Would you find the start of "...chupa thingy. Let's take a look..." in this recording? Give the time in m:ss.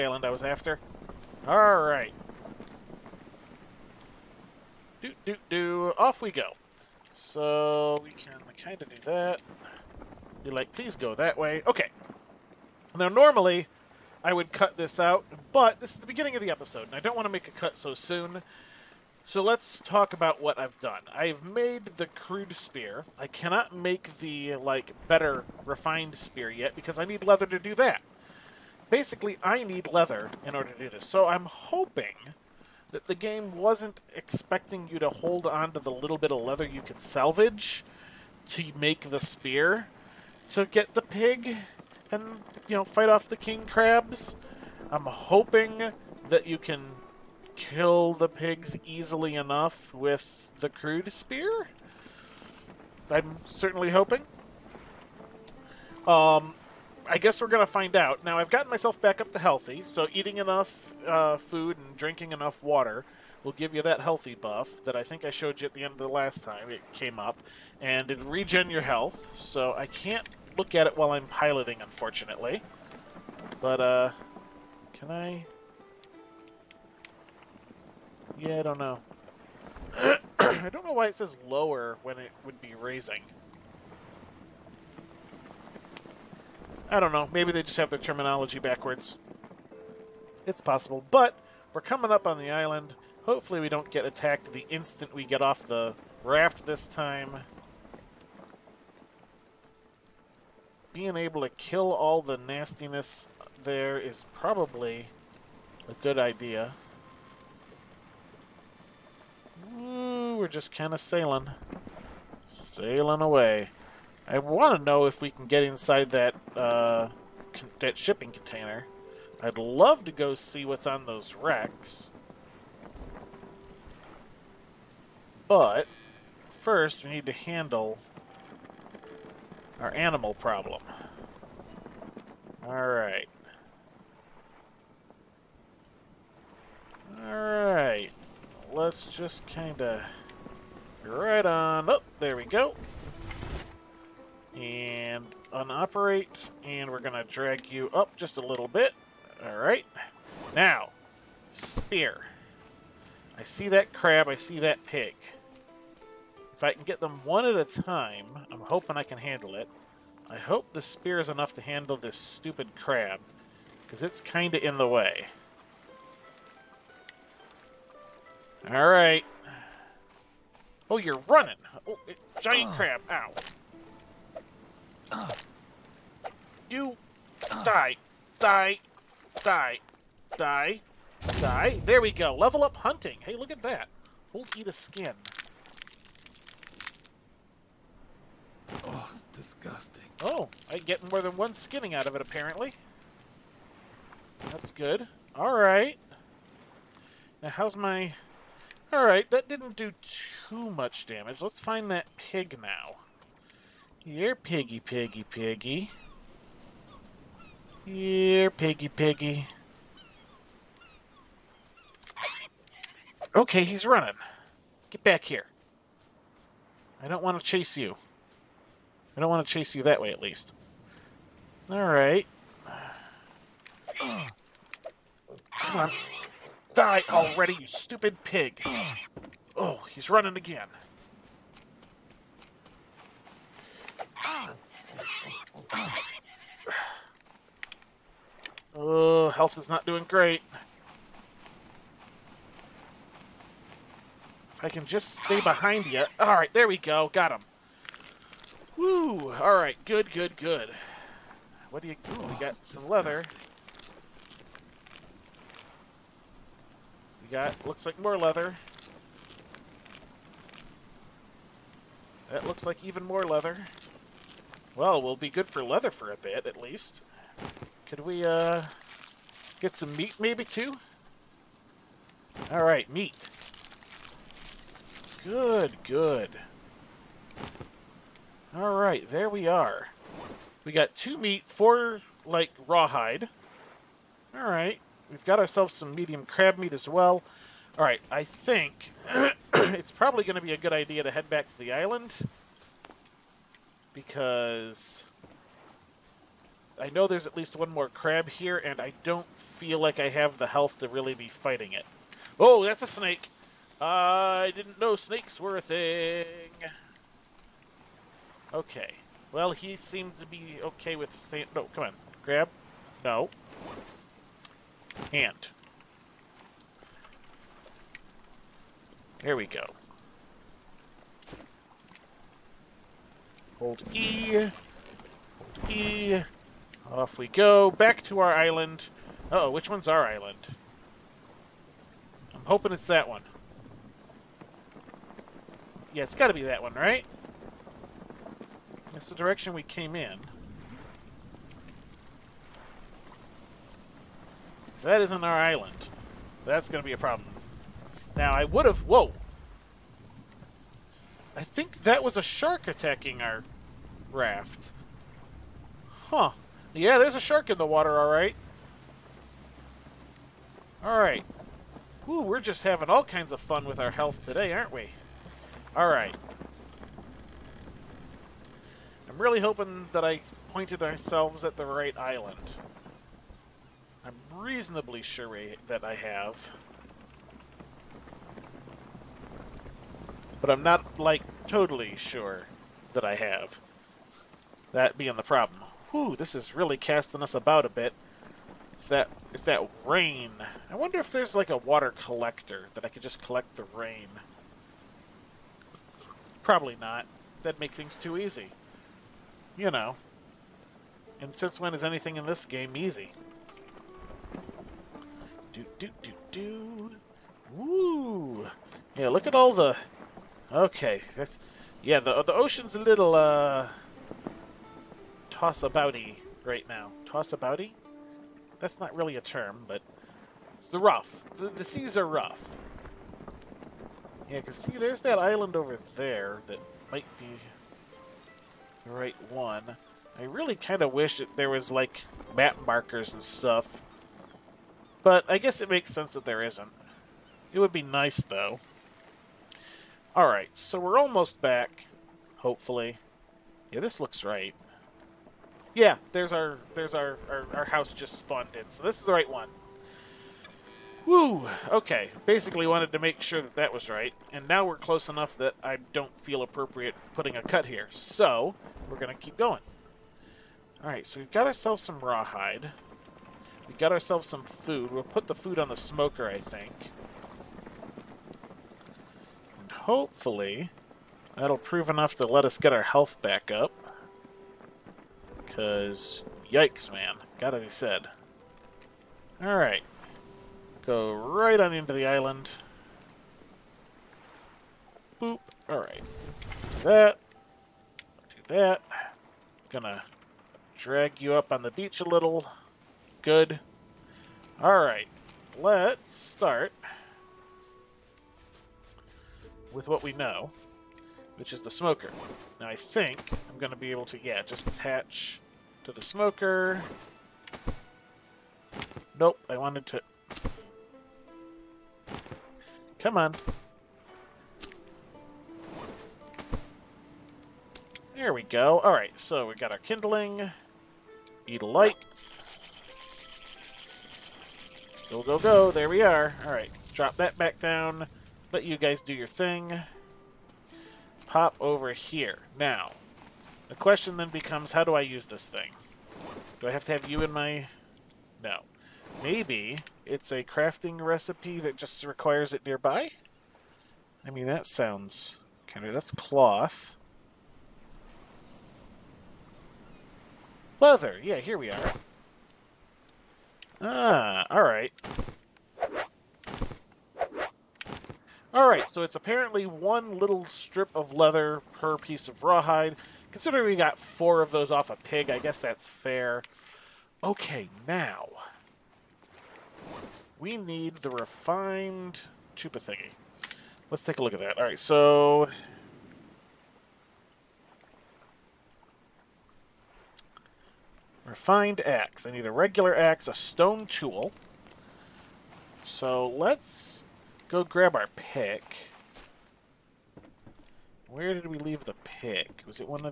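9:32.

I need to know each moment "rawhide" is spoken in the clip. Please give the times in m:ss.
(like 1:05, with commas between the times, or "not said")
4:42, 7:41, 9:22.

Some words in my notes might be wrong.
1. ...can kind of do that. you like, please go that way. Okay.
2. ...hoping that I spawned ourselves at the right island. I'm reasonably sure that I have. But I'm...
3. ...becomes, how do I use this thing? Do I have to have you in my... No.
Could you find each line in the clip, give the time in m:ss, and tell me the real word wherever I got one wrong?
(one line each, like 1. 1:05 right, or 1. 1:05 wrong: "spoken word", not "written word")
1. 0:08 right
2. 6:09 wrong: "pointed", not "spawned"
3. 8:54 right.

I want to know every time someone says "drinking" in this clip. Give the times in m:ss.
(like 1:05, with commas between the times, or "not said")
1:01.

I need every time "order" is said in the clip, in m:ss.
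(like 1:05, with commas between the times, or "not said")
0:30.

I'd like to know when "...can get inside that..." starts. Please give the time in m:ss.
1:55.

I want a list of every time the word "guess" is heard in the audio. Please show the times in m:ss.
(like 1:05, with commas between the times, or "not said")
0:57, 7:15, 9:25.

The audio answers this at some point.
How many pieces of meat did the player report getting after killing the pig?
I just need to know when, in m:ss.
4:40.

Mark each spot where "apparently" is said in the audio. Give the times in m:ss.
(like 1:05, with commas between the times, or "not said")
3:12, 9:19.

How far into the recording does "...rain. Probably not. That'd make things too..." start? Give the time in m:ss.
6:33.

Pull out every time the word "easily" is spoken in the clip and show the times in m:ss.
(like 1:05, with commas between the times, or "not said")
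0:48.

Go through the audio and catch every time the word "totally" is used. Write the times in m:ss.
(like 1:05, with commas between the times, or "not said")
6:21.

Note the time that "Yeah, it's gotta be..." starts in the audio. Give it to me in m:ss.
5:35.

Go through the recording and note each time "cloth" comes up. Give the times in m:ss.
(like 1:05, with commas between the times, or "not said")
9:06.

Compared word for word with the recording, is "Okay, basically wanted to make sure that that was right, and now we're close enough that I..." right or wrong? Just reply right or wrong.
right.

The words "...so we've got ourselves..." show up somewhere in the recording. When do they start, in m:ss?
7:41.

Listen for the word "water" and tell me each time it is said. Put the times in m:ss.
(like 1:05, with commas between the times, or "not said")
1:02, 5:57, 6:31.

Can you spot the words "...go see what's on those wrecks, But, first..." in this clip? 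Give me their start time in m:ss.
2:00.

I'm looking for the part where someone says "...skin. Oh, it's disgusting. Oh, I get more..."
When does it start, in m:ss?
3:04.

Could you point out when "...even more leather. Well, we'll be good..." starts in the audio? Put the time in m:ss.
4:22.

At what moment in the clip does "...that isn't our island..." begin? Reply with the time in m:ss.
5:44.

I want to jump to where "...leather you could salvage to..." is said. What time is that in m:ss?
0:36.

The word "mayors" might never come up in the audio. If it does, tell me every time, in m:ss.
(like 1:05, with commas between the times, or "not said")
not said.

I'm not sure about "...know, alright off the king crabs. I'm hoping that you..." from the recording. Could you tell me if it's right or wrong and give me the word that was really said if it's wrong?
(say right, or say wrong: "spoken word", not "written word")
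wrong: "fight", not "alright".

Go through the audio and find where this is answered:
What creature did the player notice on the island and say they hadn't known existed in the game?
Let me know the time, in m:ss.
5:02.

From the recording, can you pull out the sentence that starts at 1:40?
being able to kill all the nastiness there is probably a good idea.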